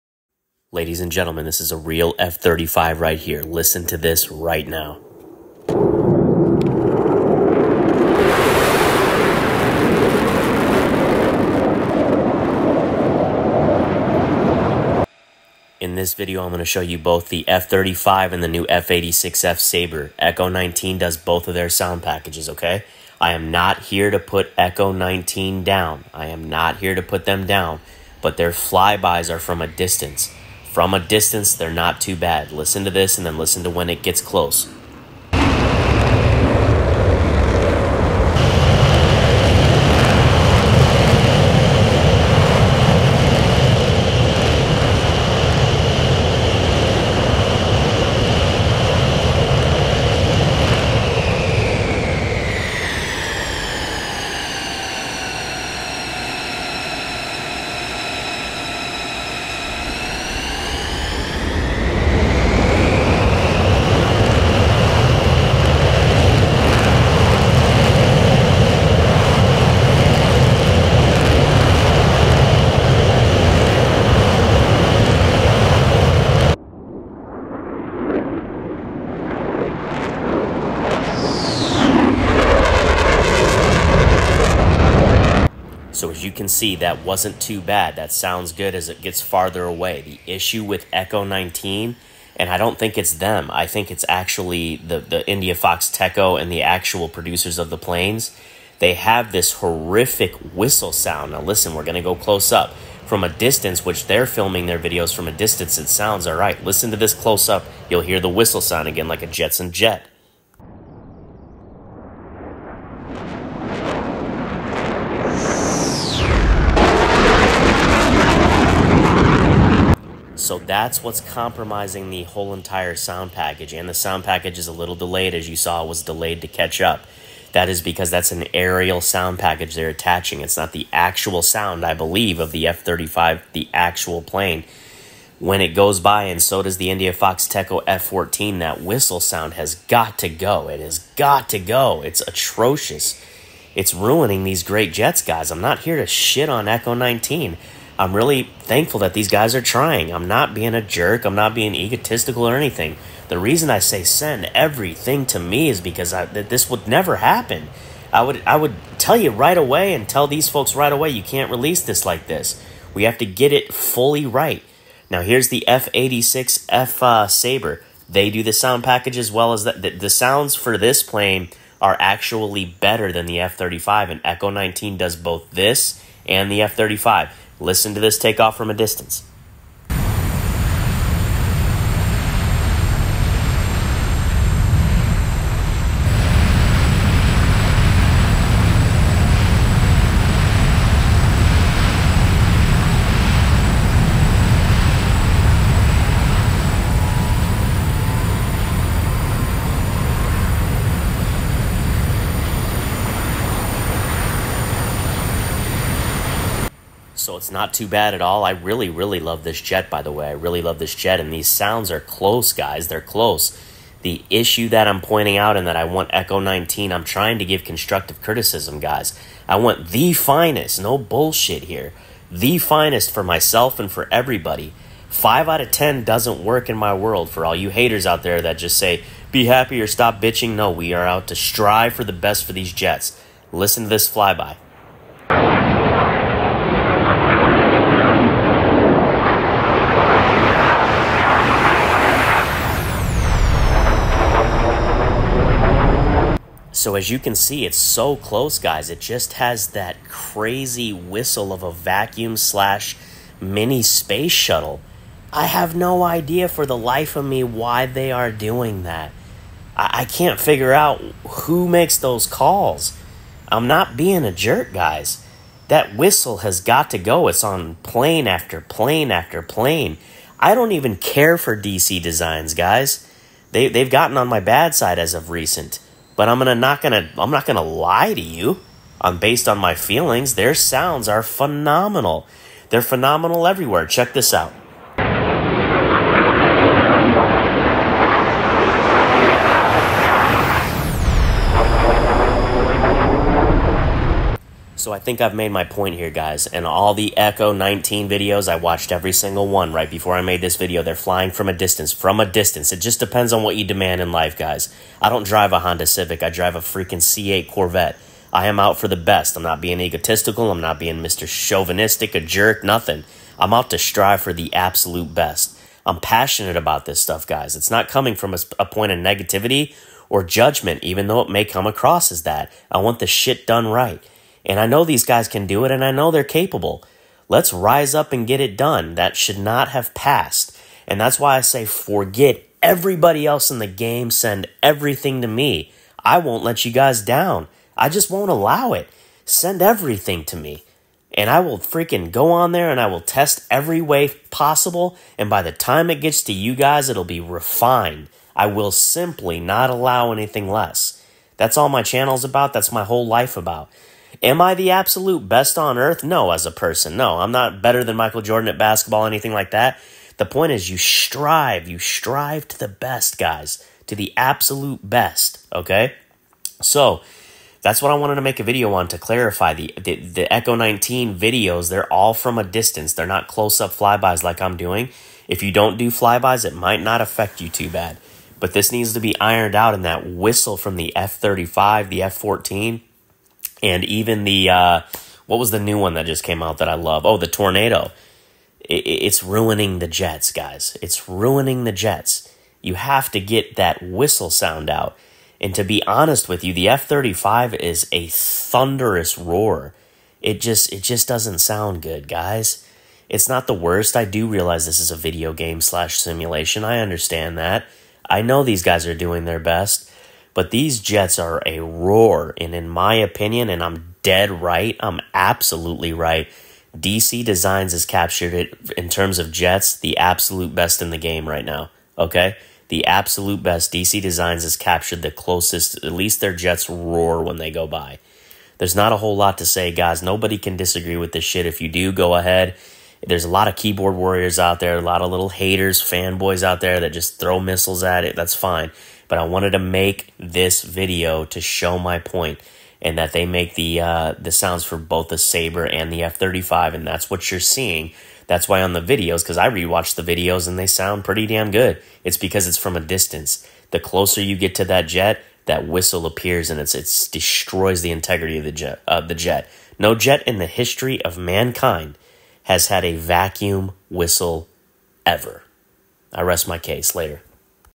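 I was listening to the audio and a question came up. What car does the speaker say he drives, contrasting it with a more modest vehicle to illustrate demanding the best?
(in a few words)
C8 Corvette.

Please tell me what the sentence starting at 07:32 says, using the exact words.
It's because it's from a distance.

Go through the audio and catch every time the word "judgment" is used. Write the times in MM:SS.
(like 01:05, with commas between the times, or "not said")
05:20.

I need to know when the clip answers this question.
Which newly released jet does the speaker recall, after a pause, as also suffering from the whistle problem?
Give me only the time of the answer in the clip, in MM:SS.
06:27.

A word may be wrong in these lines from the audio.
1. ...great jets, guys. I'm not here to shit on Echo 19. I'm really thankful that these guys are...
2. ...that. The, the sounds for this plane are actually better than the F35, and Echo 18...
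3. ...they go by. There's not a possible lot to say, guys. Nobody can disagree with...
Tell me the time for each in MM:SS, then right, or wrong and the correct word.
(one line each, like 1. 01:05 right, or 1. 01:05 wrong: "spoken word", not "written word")
1. 02:24 right
2. 02:49 wrong: "19", not "18"
3. 07:07 wrong: "whole", not "possible".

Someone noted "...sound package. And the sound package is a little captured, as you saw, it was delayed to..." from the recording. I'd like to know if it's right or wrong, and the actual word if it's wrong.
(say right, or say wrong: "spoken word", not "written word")
wrong: "delayed", not "captured".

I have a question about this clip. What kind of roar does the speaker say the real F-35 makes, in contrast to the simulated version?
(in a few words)
thunderous roar.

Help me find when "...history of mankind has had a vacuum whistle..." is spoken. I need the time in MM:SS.
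07:40.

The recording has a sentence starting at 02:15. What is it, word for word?
When it goes by, and so does the IndiaFoxtEcho F 14, that whistle sound has got to go.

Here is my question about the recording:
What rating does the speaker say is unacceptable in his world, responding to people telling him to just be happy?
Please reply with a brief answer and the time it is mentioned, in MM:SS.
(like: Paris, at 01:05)
5 out of 10, at 03:45.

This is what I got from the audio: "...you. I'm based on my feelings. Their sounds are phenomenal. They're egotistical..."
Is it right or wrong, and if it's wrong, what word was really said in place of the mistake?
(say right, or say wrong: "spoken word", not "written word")
wrong: "phenomenal", not "egotistical".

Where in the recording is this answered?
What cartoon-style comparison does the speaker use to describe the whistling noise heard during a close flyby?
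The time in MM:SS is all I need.
01:49.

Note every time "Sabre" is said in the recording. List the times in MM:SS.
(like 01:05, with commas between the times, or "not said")
00:19, 02:47, 07:25.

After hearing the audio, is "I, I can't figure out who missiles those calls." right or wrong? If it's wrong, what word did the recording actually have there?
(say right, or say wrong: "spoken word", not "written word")
wrong: "makes", not "missiles".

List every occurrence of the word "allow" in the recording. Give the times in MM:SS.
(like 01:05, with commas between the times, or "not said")
05:38, 05:49.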